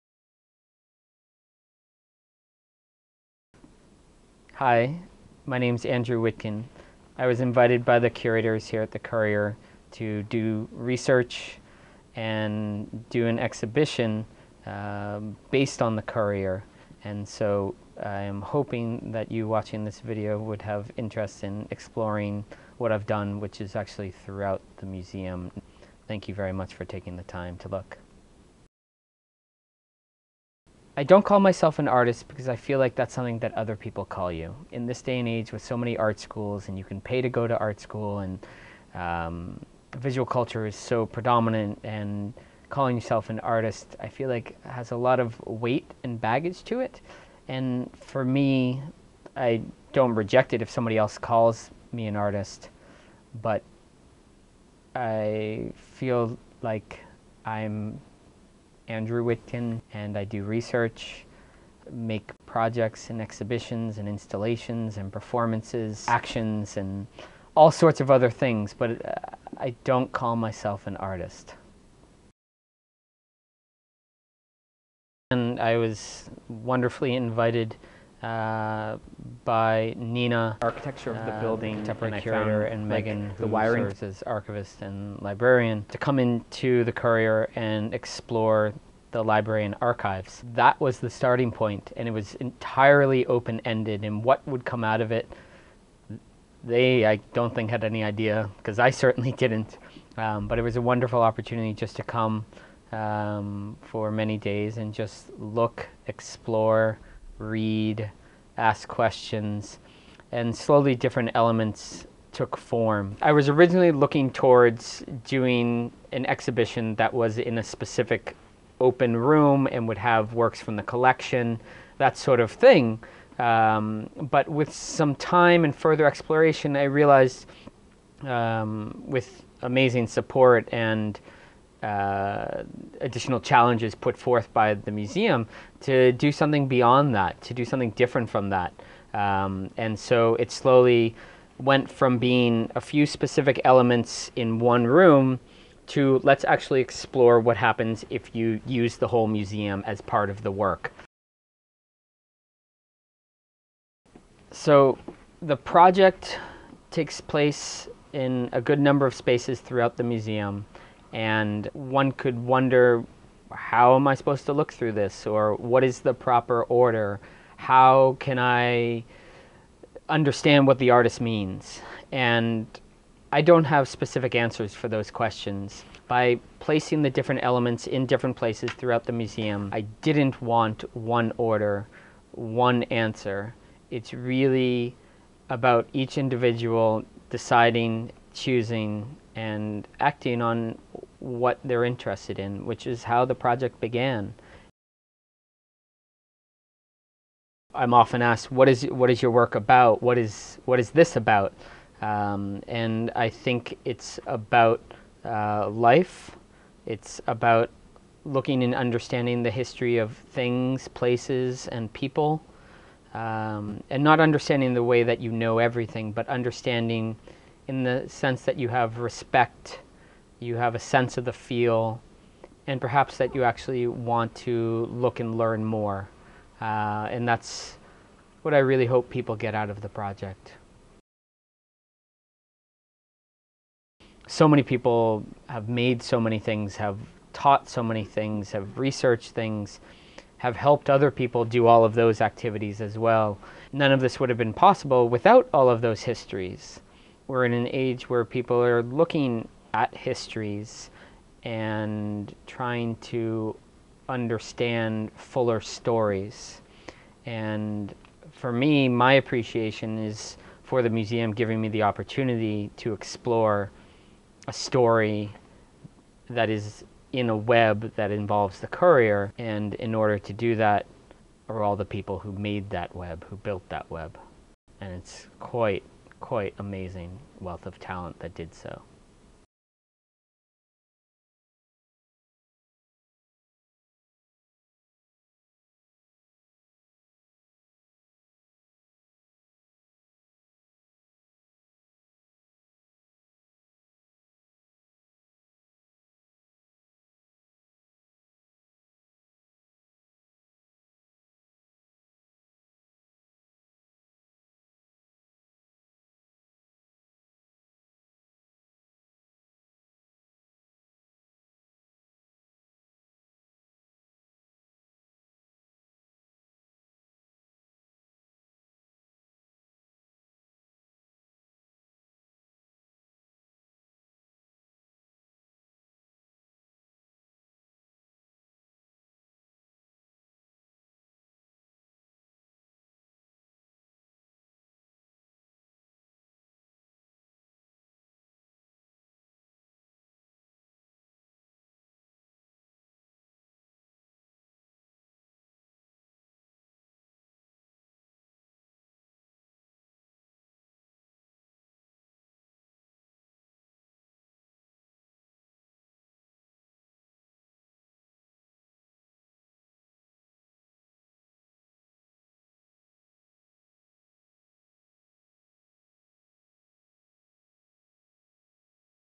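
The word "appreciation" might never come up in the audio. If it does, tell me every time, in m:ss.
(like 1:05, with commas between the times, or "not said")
4:19.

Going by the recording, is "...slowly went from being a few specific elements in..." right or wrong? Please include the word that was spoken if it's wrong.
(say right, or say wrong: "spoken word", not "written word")
right.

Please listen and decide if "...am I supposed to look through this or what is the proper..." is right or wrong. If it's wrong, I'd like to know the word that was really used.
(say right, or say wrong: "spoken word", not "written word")
right.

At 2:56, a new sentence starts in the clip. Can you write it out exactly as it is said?
By placing the different elements in different places throughout the museum, I didn't want one order, one answer.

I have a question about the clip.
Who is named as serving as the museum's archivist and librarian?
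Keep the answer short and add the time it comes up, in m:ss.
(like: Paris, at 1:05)
Megan, at 1:22.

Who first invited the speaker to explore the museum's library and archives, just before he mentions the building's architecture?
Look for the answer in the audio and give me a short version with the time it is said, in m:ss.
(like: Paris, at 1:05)
Nina, at 1:19.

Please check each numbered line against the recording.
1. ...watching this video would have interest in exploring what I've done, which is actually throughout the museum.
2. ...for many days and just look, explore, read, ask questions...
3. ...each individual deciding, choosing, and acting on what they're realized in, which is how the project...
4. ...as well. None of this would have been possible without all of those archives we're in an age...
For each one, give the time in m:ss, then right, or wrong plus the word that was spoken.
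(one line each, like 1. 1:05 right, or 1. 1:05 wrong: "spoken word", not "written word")
1. 0:19 right
2. 1:43 right
3. 3:05 wrong: "interested", not "realized"
4. 4:02 wrong: "histories", not "archives".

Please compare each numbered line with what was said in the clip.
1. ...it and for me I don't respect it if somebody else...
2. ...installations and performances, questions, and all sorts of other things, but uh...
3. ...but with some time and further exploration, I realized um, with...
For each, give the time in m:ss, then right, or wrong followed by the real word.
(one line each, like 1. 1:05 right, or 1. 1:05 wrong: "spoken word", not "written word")
1. 0:46 wrong: "reject", not "respect"
2. 1:04 wrong: "actions", not "questions"
3. 2:04 right.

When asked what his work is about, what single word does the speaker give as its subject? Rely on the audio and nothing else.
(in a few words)
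life.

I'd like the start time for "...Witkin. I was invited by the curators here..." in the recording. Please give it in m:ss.
0:06.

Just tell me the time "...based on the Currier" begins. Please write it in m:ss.
0:15.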